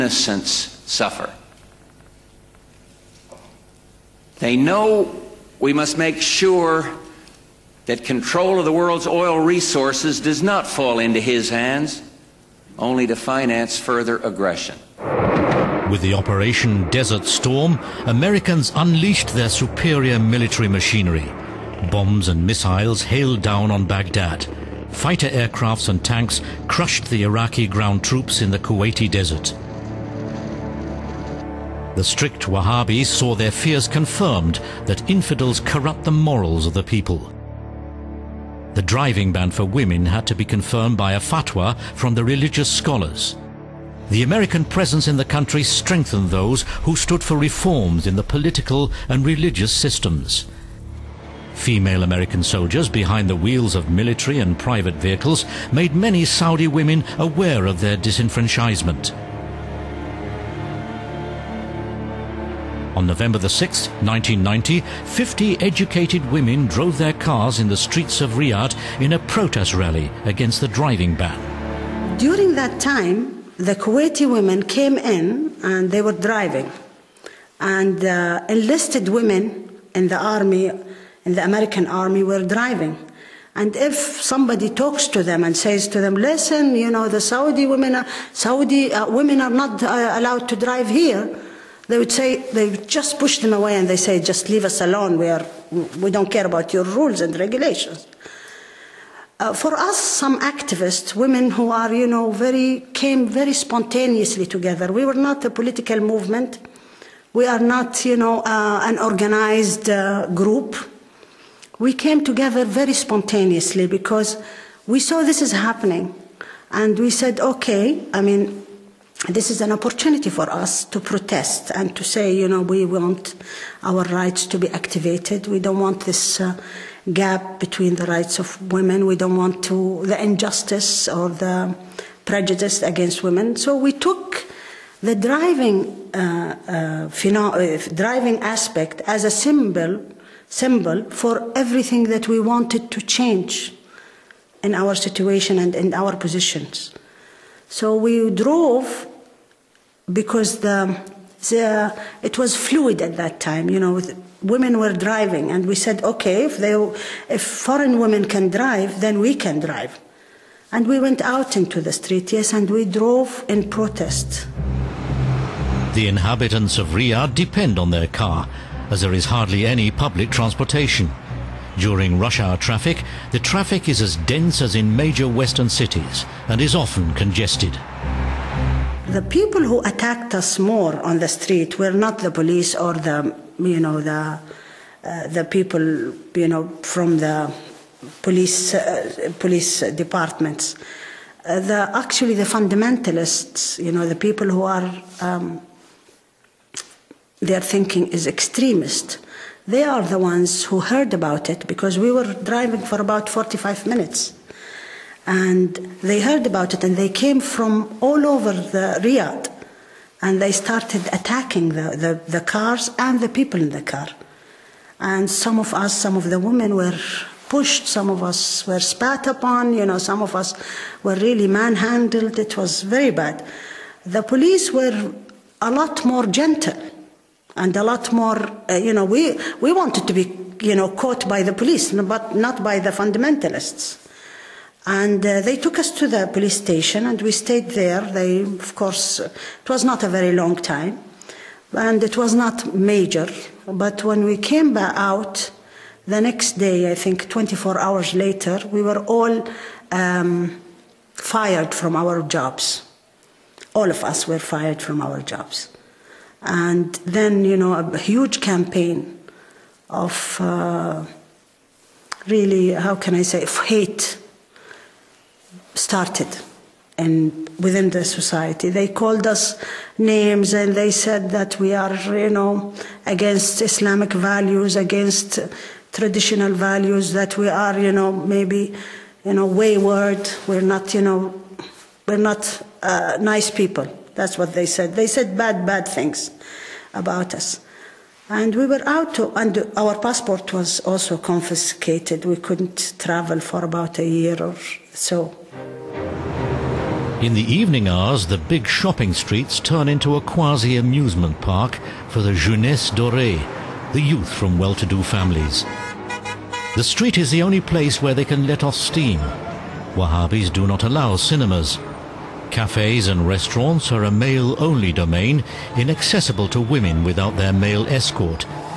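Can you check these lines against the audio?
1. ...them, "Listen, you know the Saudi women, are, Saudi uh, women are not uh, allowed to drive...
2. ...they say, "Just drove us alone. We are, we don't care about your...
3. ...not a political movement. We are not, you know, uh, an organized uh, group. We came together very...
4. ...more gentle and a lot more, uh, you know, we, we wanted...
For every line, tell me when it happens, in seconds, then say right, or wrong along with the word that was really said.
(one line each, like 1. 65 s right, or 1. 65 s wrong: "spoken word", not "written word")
1. 86 s right
2. 93 s wrong: "leave", not "drove"
3. 105 s right
4. 226 s right.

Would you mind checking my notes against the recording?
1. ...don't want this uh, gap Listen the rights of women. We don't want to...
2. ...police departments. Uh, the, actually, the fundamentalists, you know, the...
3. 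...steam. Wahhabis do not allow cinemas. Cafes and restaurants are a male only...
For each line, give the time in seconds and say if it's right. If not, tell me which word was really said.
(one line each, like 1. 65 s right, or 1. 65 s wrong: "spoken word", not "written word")
1. 125 s wrong: "between", not "Listen"
2. 189 s right
3. 308 s right.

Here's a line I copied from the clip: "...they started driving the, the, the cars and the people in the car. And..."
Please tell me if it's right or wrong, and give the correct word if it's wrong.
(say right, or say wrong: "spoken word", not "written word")
wrong: "attacking", not "driving".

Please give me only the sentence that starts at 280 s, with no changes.
We're not, you know, we're not uh, nice people.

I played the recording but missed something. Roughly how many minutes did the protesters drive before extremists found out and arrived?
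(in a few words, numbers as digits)
45.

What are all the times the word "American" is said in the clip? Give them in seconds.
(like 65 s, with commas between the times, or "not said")
18 s, 44 s, 52 s, 81 s.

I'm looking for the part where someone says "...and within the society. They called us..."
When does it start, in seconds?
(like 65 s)
266 s.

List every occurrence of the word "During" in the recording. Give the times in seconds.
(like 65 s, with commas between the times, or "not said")
72 s, 171 s.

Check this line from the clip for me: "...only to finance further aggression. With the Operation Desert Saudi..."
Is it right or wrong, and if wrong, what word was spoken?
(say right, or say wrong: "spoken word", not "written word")
wrong: "Storm", not "Saudi".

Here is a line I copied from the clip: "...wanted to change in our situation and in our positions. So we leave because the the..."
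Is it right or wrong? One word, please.
wrong.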